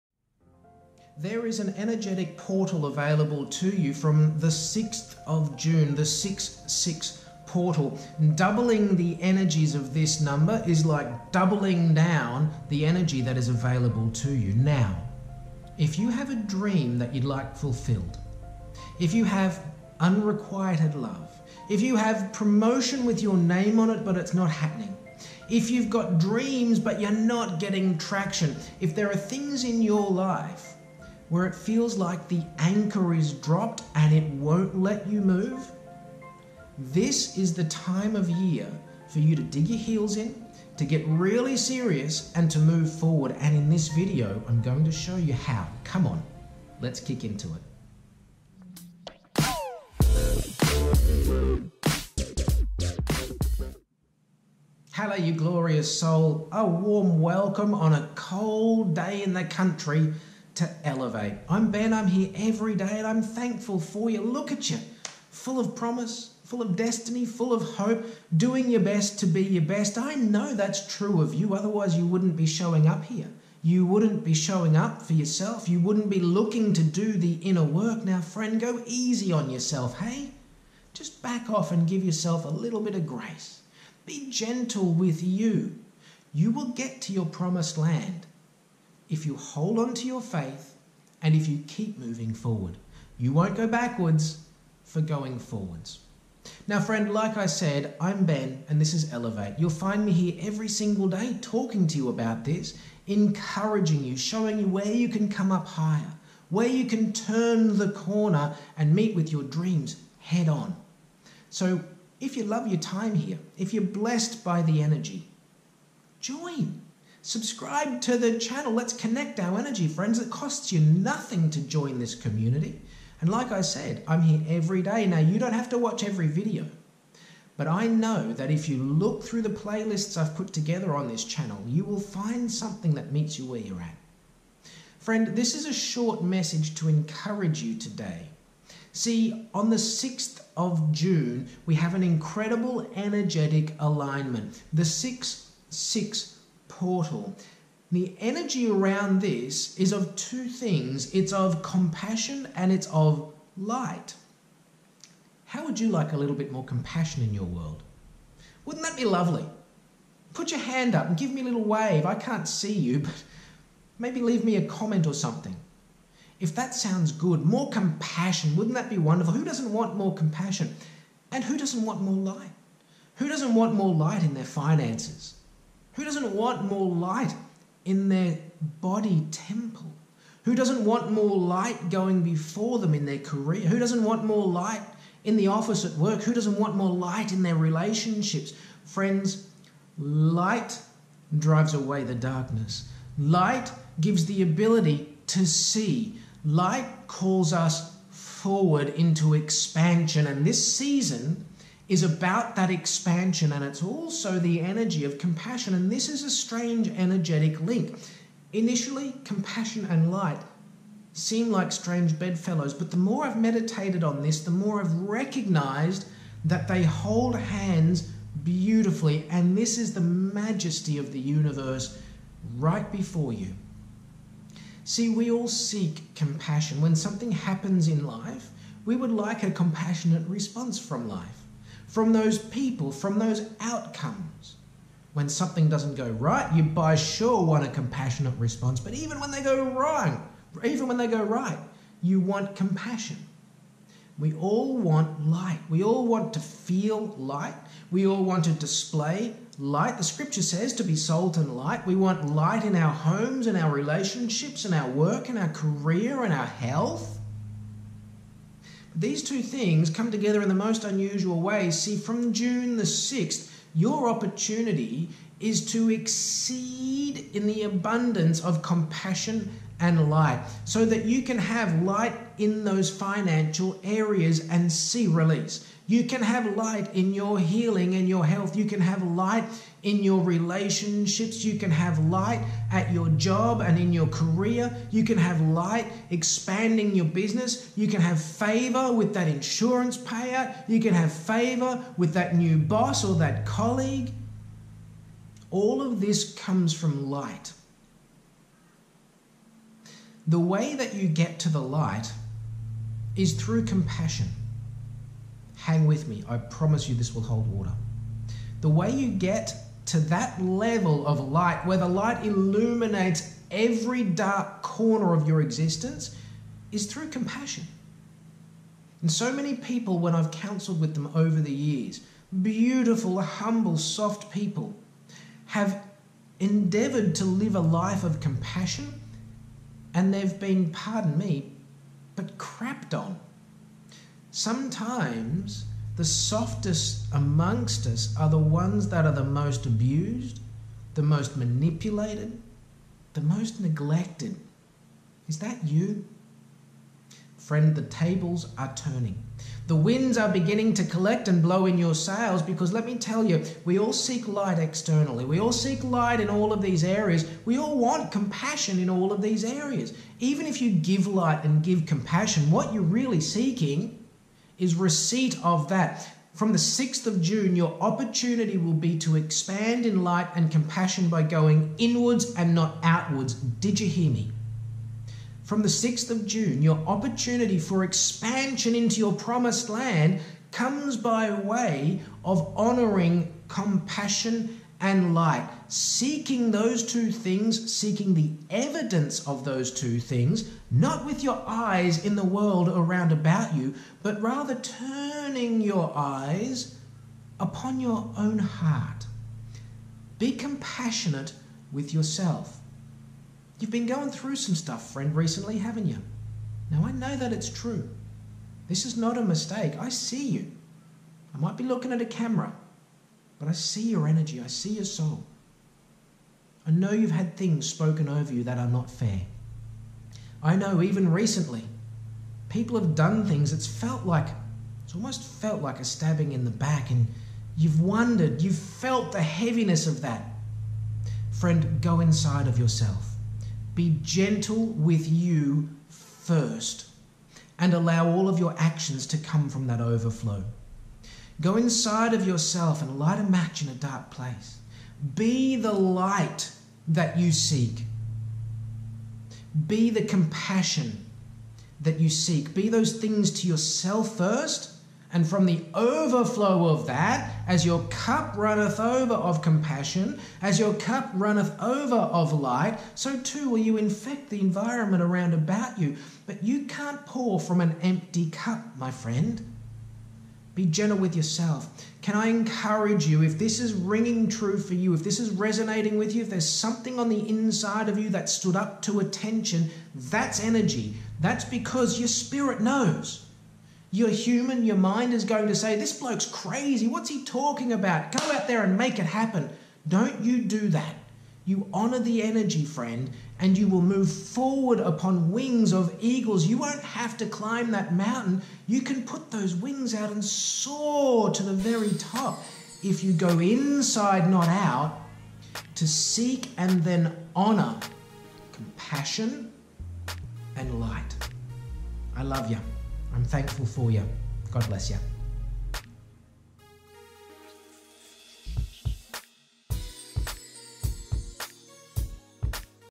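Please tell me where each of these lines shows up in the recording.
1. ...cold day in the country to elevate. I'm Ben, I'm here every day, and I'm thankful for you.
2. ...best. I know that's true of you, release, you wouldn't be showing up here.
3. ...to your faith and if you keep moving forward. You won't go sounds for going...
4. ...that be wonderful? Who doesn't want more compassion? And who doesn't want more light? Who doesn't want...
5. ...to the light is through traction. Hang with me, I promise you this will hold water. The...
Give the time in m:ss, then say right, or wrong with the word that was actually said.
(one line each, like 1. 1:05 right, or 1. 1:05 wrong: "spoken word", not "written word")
1. 0:58 right
2. 1:09 wrong: "otherwise", not "release"
3. 1:29 wrong: "backwards", not "sounds"
4. 2:48 right
5. 5:01 wrong: "compassion", not "traction".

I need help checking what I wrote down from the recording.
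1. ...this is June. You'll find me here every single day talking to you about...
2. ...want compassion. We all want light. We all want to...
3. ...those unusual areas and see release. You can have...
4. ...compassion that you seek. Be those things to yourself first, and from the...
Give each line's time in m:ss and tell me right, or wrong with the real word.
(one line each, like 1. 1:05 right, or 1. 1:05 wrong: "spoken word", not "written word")
1. 1:38 wrong: "Elevate", not "June"
2. 4:02 right
3. 4:32 wrong: "financial", not "unusual"
4. 7:30 right.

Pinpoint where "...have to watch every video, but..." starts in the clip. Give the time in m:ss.
2:05.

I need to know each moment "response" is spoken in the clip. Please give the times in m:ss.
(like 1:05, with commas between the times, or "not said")
3:50, 3:58.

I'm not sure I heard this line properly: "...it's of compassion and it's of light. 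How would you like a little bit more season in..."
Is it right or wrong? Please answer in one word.
wrong.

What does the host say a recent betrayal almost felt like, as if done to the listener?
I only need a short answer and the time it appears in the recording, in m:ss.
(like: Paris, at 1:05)
Stabbing in the back, at 7:05.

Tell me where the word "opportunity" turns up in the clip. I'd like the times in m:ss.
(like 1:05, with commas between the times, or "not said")
4:24, 6:07, 6:16.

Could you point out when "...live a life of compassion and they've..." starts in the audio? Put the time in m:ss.
5:27.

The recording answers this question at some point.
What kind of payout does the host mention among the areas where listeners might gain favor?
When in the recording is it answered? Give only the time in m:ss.
4:49.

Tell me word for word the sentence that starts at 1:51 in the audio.
So, if you love your time here, if you're blessed by the energy, join.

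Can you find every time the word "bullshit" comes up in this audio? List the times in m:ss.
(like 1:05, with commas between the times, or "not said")
not said.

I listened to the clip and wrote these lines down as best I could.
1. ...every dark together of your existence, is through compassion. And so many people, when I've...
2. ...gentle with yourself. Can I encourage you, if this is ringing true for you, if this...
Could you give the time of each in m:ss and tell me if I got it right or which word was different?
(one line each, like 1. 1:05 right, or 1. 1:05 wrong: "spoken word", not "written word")
1. 5:13 wrong: "corner", not "together"
2. 7:50 right.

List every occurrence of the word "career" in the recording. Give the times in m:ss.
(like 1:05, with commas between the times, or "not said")
3:03, 4:15, 4:44.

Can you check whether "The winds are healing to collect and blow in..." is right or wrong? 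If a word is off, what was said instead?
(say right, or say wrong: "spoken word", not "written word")
wrong: "beginning", not "healing".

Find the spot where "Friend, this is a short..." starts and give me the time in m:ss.
2:14.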